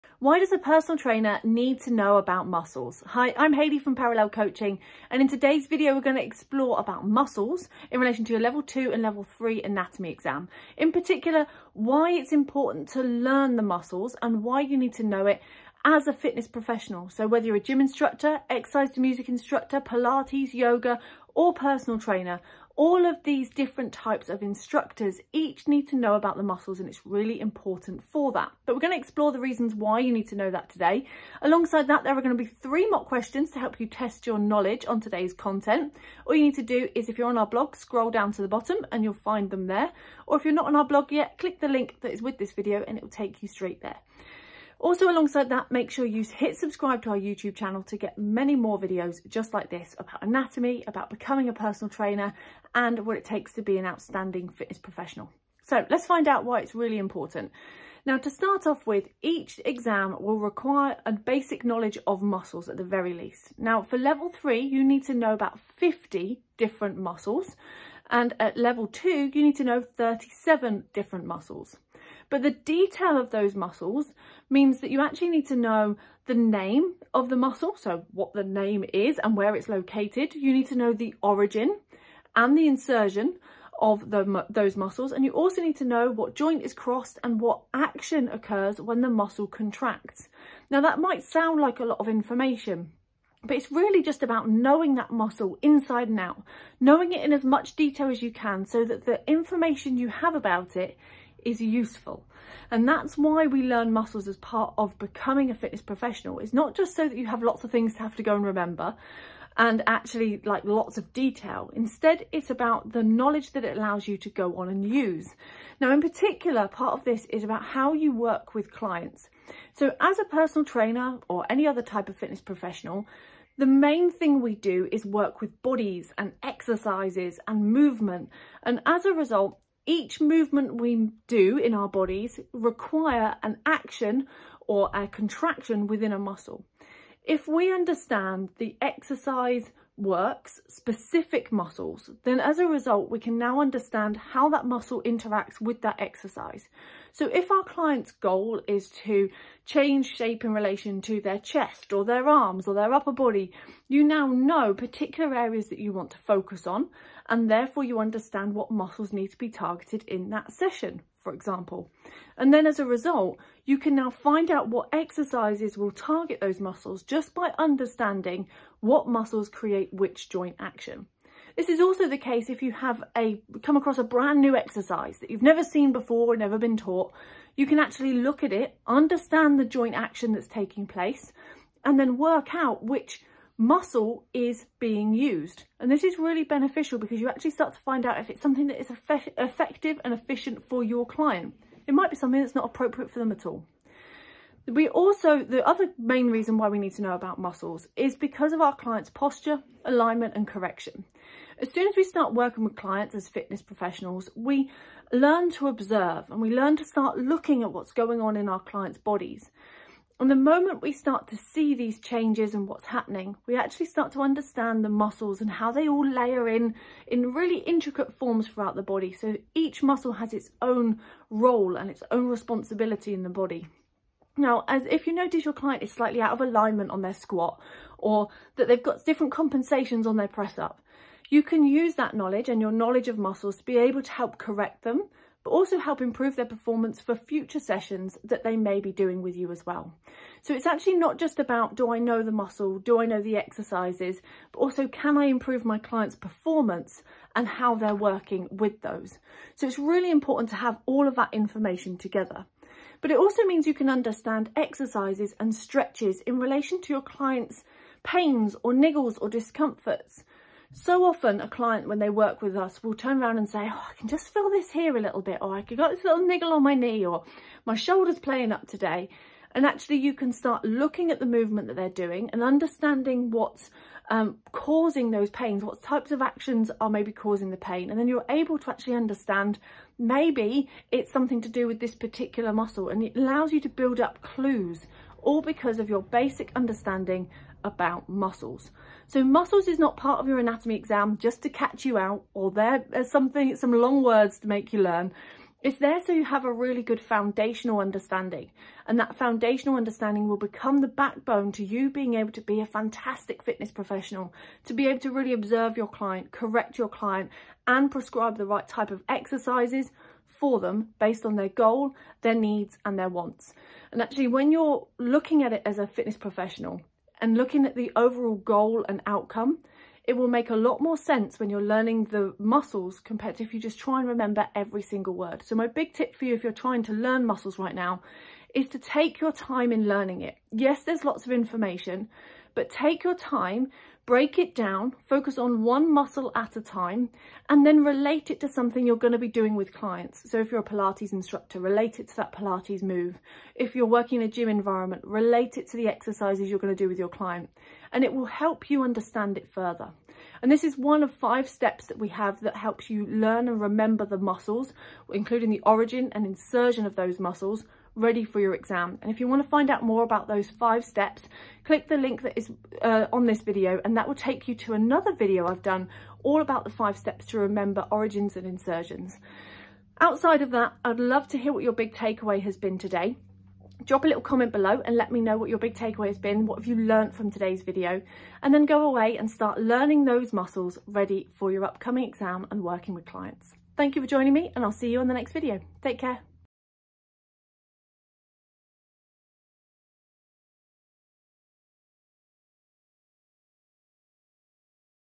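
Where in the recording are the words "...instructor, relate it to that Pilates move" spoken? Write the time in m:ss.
5:41.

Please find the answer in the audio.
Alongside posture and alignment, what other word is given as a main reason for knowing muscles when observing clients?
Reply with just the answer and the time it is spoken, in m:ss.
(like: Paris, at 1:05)
correction, at 3:20.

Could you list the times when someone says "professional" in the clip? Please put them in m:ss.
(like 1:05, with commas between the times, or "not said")
0:16, 0:54, 1:45, 2:02, 3:23, 5:03, 5:16.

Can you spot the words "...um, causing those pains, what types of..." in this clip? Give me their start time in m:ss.
4:34.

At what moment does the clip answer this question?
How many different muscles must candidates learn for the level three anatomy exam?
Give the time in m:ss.
1:05.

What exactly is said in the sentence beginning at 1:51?
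Instead, it's about the knowledge that it allows you to go on and use.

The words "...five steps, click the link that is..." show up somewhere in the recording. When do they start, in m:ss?
6:00.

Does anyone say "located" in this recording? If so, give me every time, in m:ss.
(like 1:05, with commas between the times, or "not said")
1:19.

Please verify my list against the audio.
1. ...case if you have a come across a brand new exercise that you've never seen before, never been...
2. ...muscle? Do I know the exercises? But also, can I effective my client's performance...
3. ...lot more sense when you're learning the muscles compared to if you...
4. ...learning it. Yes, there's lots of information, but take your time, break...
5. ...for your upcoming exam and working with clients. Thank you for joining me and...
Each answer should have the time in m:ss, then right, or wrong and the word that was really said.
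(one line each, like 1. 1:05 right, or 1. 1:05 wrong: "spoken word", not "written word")
1. 2:52 right
2. 4:02 wrong: "improve", not "effective"
3. 5:20 right
4. 5:29 right
5. 6:21 right.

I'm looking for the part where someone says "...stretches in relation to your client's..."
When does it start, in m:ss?
4:15.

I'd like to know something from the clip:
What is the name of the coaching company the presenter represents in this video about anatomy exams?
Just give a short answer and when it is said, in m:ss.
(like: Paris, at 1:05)
Parallel Coaching, at 0:03.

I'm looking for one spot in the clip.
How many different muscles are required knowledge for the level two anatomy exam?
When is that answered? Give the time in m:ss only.
1:09.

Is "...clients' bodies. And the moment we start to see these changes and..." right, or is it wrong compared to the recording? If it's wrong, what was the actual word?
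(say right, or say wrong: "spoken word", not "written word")
right.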